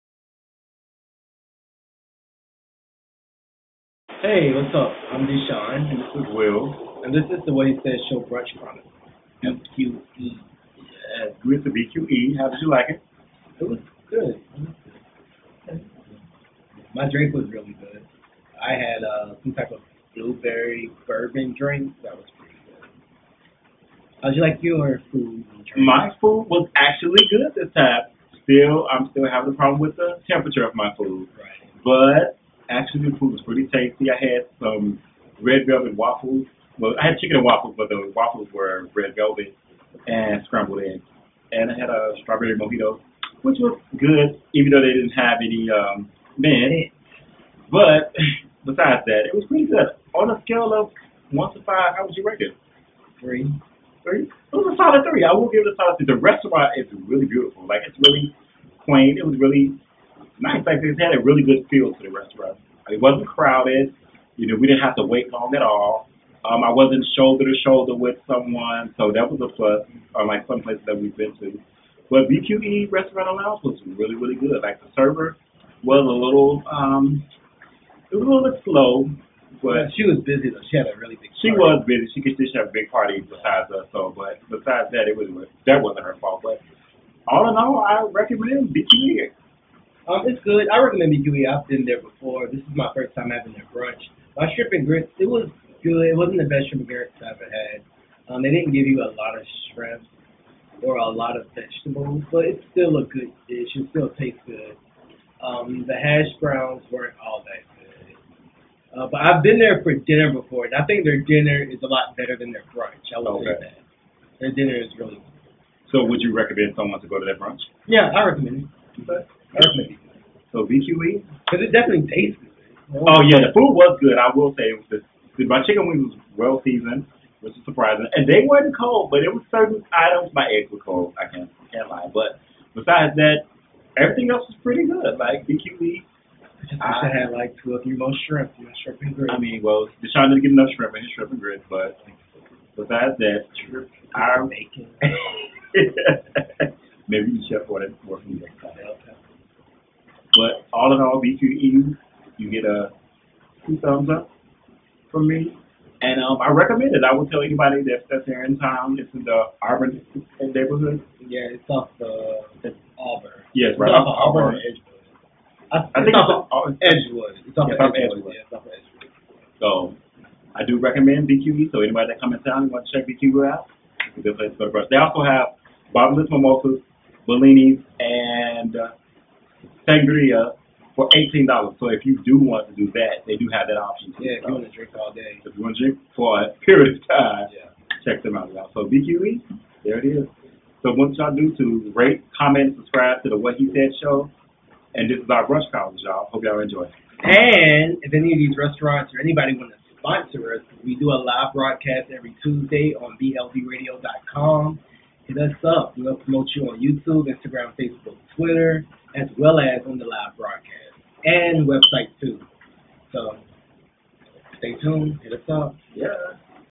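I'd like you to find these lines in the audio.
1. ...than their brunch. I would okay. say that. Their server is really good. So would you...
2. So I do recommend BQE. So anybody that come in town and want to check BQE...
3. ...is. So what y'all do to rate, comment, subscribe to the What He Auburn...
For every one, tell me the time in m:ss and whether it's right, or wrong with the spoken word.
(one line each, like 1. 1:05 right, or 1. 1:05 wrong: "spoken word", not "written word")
1. 1:52 wrong: "dinner", not "server"
2. 2:49 right
3. 3:10 wrong: "Said", not "Auburn".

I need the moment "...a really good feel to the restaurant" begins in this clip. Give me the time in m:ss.
1:01.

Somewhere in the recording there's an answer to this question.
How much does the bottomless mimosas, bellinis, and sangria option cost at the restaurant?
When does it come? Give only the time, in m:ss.
3:01.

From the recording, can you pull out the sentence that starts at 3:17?
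And if any of these restaurants or anybody want to sponsor us, we do a live broadcast every Tuesday on bldradio.com.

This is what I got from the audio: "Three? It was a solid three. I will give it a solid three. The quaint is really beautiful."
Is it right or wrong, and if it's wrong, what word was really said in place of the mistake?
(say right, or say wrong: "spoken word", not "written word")
wrong: "restaurant", not "quaint".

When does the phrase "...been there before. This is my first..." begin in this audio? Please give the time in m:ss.
1:31.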